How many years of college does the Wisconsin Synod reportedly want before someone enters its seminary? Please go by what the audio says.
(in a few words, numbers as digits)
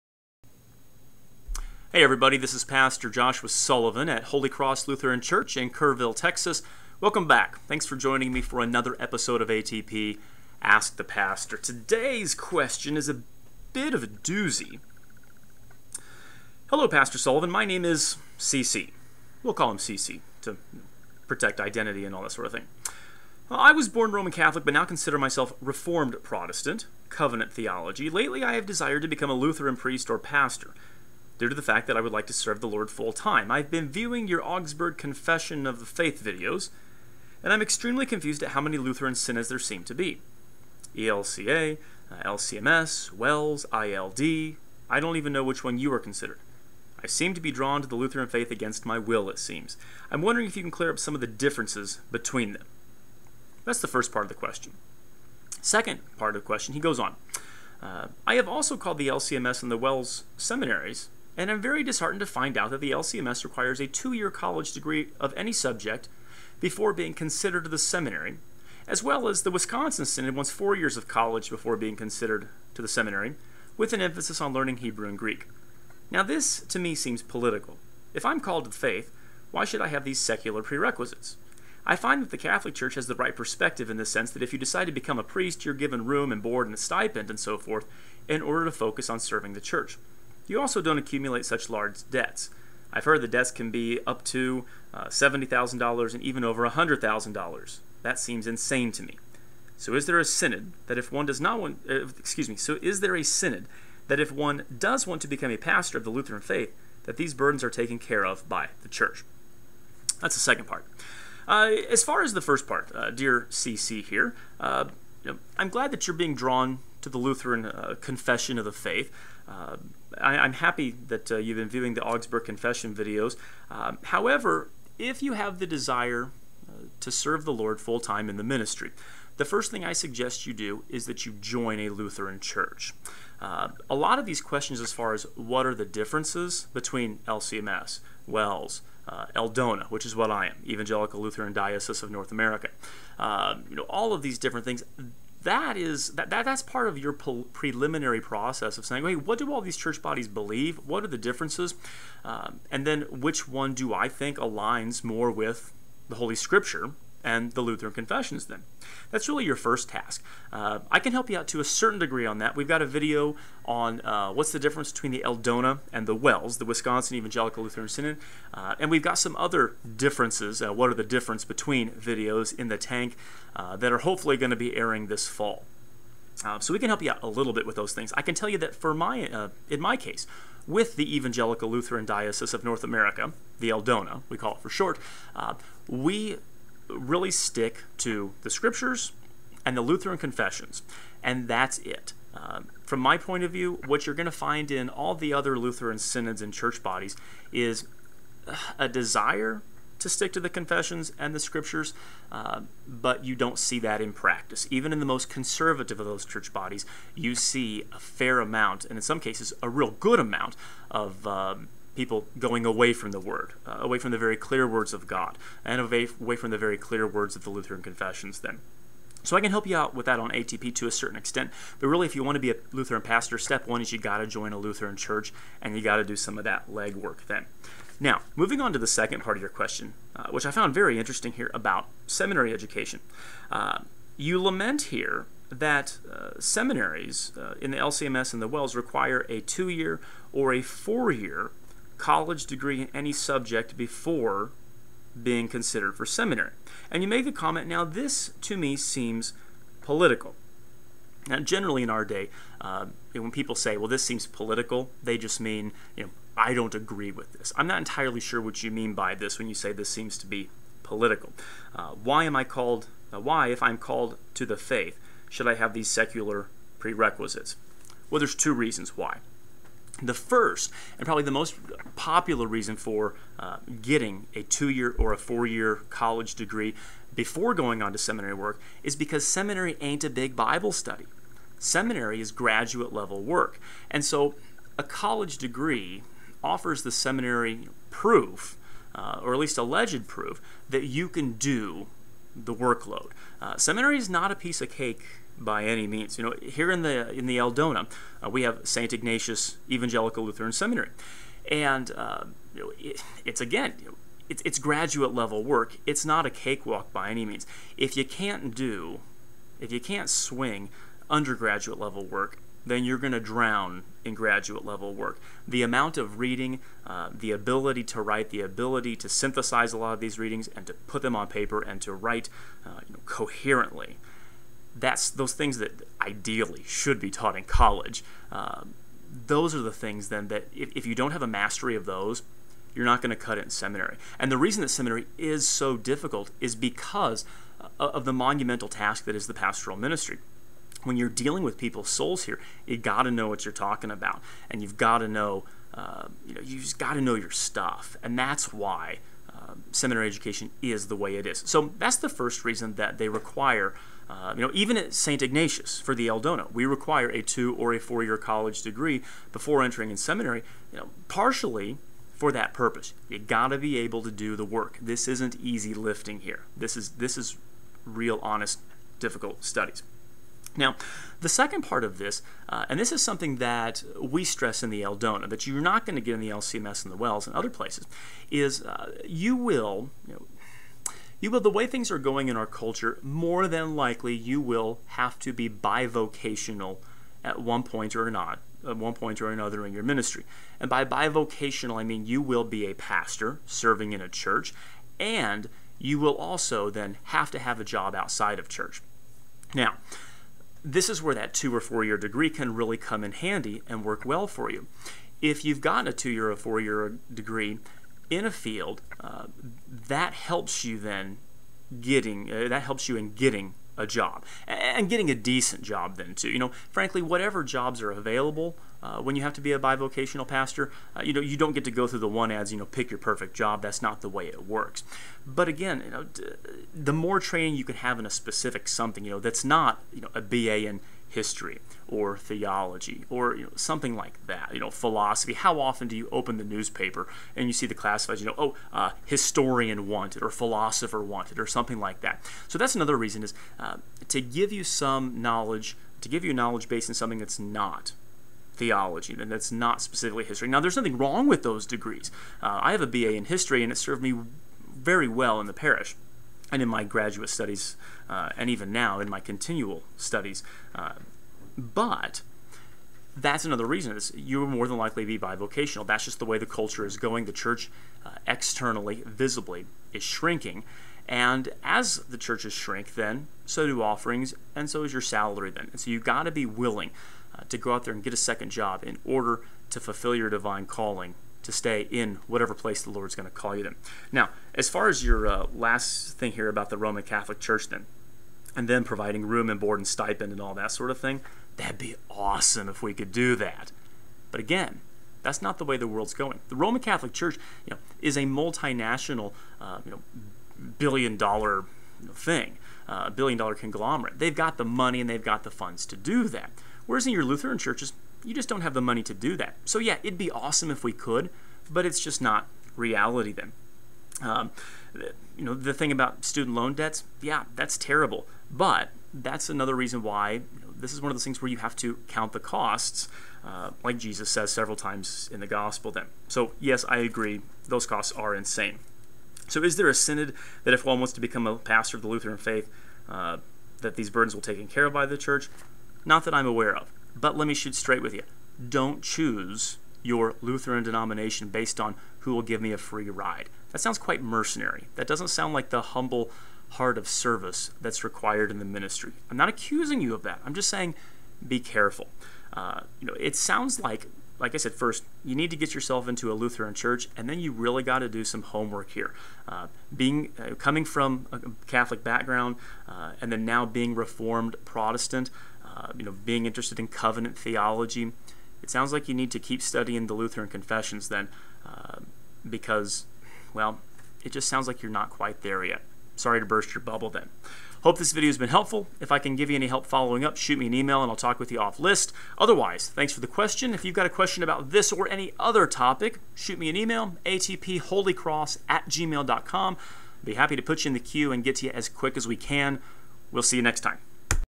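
4.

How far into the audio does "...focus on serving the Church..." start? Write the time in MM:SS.
01:28.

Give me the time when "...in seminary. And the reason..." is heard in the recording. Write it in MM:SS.
05:33.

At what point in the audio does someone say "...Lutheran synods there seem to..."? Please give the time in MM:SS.
00:38.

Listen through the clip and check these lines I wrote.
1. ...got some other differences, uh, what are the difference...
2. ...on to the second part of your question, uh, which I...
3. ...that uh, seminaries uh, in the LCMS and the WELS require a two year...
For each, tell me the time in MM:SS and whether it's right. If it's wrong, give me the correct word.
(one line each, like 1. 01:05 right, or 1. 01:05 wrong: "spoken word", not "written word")
1. 02:49 right
2. 03:48 right
3. 03:55 right.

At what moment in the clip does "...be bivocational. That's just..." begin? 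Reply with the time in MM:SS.
07:45.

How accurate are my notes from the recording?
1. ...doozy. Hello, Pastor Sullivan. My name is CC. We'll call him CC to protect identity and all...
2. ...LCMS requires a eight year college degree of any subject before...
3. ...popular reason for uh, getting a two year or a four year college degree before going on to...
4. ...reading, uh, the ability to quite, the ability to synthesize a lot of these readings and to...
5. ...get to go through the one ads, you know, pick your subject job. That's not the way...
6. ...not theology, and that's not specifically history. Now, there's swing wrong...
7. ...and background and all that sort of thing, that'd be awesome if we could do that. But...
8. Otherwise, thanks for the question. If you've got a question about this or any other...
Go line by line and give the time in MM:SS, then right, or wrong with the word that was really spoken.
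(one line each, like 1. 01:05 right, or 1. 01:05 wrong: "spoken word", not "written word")
1. 00:14 right
2. 01:02 wrong: "two", not "eight"
3. 04:31 right
4. 05:16 wrong: "write", not "quite"
5. 07:01 wrong: "perfect", not "subject"
6. 07:27 wrong: "nothing", not "swing"
7. 08:09 wrong: "stipend", not "background"
8. 09:42 right.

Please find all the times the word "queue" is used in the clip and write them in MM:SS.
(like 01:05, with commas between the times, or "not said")
09:50.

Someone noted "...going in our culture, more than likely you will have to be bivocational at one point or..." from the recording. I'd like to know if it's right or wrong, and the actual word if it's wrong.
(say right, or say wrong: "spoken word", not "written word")
right.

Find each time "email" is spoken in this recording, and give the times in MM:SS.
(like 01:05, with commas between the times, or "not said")
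09:40, 09:46.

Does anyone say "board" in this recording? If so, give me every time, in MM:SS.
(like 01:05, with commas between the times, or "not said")
01:26, 08:09.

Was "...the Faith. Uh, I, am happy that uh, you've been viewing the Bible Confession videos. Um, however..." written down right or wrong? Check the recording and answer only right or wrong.
wrong.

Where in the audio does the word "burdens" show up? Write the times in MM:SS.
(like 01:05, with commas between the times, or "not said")
01:47, 08:54.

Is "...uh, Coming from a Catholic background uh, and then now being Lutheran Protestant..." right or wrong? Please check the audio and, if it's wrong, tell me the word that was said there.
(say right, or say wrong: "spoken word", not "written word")
wrong: "Reformed", not "Lutheran".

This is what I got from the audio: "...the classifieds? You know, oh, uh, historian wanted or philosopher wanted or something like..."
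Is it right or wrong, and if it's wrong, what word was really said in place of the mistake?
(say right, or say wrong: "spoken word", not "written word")
right.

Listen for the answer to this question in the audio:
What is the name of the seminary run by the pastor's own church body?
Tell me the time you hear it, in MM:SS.
04:58.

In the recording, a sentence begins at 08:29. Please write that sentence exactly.
So yeah, it'd be awesome if we could, but it's just not reality then.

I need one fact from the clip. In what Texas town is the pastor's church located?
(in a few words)
Kerrville.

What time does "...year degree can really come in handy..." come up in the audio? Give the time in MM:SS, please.
06:41.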